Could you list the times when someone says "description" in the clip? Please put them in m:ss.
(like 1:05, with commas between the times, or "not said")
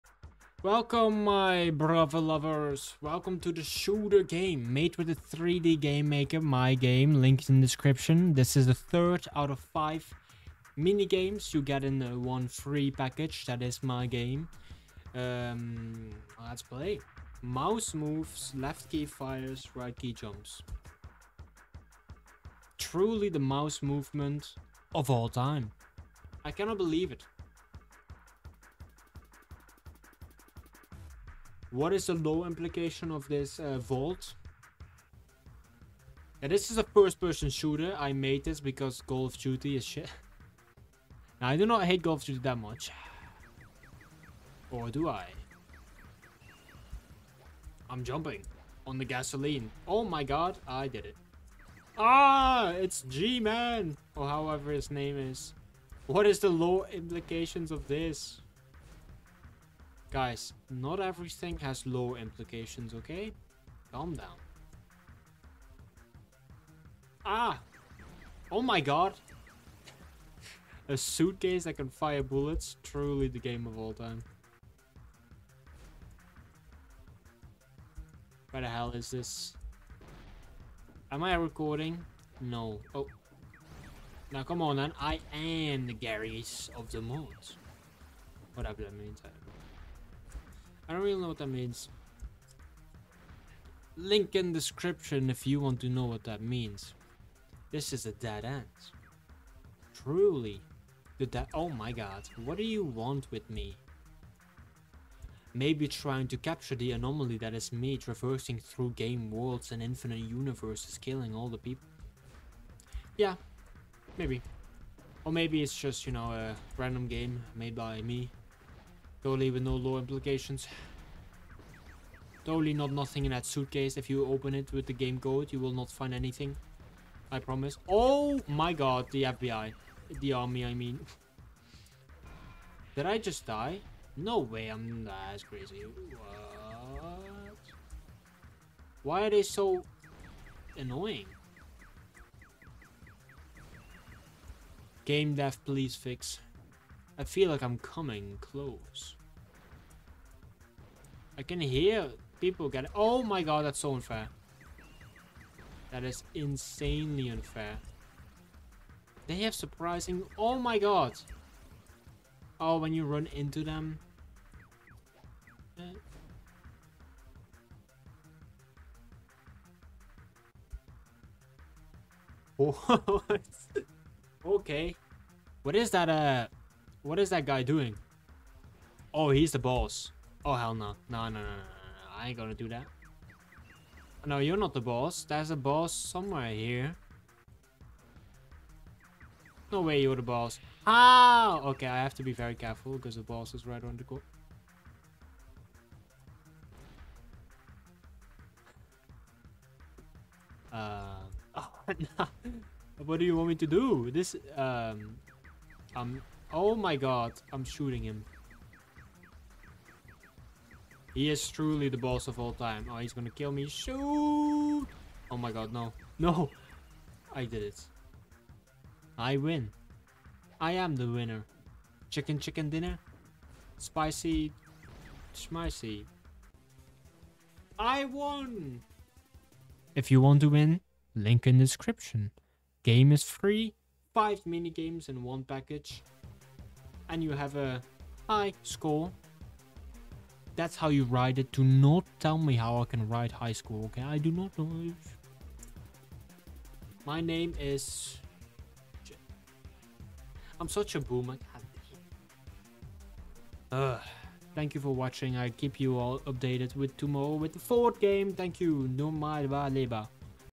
0:07, 1:34, 3:51.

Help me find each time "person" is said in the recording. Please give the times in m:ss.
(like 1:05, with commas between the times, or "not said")
0:36.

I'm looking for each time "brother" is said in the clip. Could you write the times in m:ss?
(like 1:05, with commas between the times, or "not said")
0:01.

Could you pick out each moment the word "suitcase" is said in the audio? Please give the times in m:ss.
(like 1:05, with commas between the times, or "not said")
1:10, 2:03.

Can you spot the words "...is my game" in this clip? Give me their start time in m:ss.
0:13.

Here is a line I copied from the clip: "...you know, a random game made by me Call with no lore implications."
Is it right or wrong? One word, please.
wrong.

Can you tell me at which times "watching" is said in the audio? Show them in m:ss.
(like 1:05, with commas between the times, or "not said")
4:14.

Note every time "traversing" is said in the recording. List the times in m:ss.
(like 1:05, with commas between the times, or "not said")
1:47.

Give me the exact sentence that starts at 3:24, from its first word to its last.
This, um, um, oh my god, I'm shooting him.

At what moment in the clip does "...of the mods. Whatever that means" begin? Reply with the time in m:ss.
1:26.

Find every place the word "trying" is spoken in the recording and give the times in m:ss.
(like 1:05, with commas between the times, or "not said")
1:45.